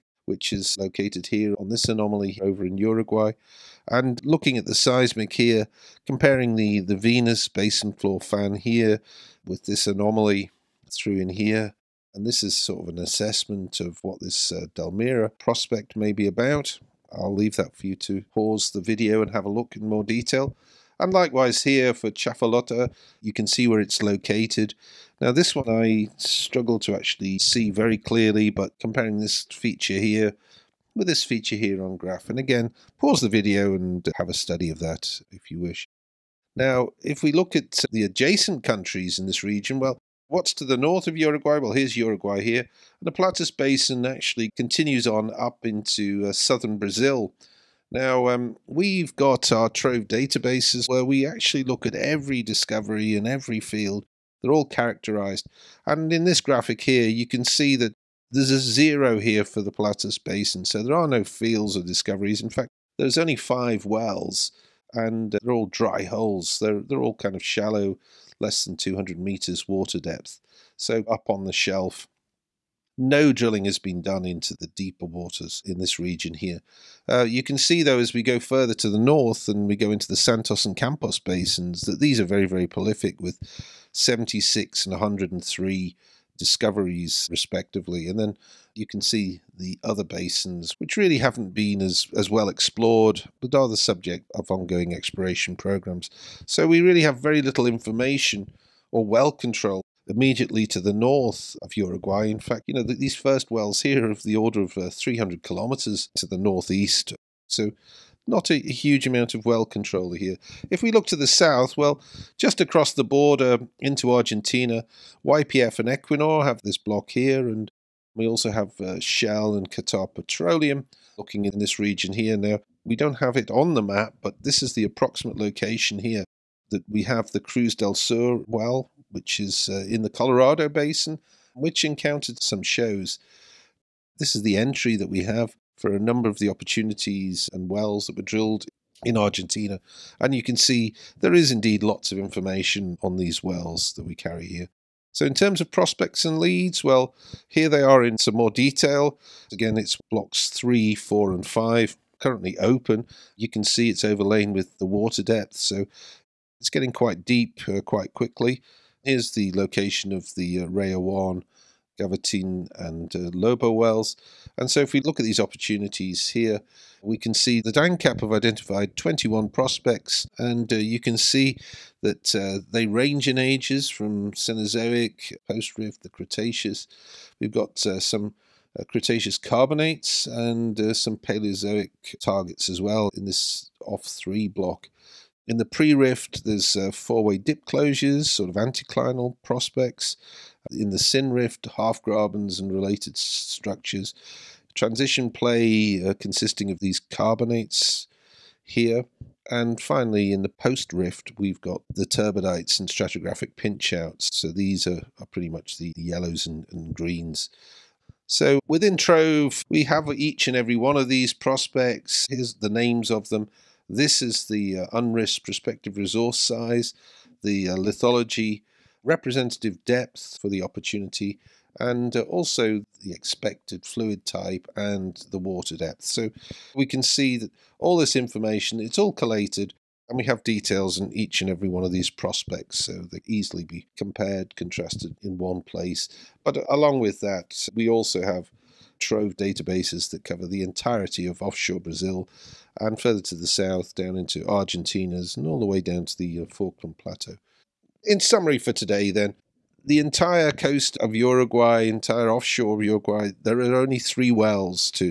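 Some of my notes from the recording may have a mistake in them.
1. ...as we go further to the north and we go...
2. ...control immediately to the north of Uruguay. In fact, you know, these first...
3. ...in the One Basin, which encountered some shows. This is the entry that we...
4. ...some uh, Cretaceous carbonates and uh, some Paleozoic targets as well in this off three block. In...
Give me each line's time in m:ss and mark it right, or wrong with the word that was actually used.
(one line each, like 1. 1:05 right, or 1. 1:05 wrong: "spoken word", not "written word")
1. 1:17 right
2. 1:39 right
3. 2:09 wrong: "Colorado", not "One"
4. 2:57 right.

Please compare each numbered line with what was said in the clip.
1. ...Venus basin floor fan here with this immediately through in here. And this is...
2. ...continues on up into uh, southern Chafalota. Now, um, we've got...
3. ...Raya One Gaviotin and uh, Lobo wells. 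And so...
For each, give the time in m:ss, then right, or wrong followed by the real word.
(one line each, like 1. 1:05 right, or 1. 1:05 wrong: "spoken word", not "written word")
1. 0:06 wrong: "anomaly", not "immediately"
2. 0:44 wrong: "Brazil", not "Chafalota"
3. 2:40 right.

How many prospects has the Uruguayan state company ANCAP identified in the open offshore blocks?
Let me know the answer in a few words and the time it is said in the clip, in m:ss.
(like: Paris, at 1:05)
21, at 2:48.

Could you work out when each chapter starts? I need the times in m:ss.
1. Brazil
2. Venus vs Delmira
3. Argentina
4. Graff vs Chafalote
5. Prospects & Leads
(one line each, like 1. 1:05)
1. 0:47
2. 0:05
3. 1:59
4. 0:30
5. 2:34.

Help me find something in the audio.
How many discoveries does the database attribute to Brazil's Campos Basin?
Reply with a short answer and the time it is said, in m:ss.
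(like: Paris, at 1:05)
103, at 1:24.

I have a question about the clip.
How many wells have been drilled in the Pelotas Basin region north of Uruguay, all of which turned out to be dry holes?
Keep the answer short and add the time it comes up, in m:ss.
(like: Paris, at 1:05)
5, at 1:03.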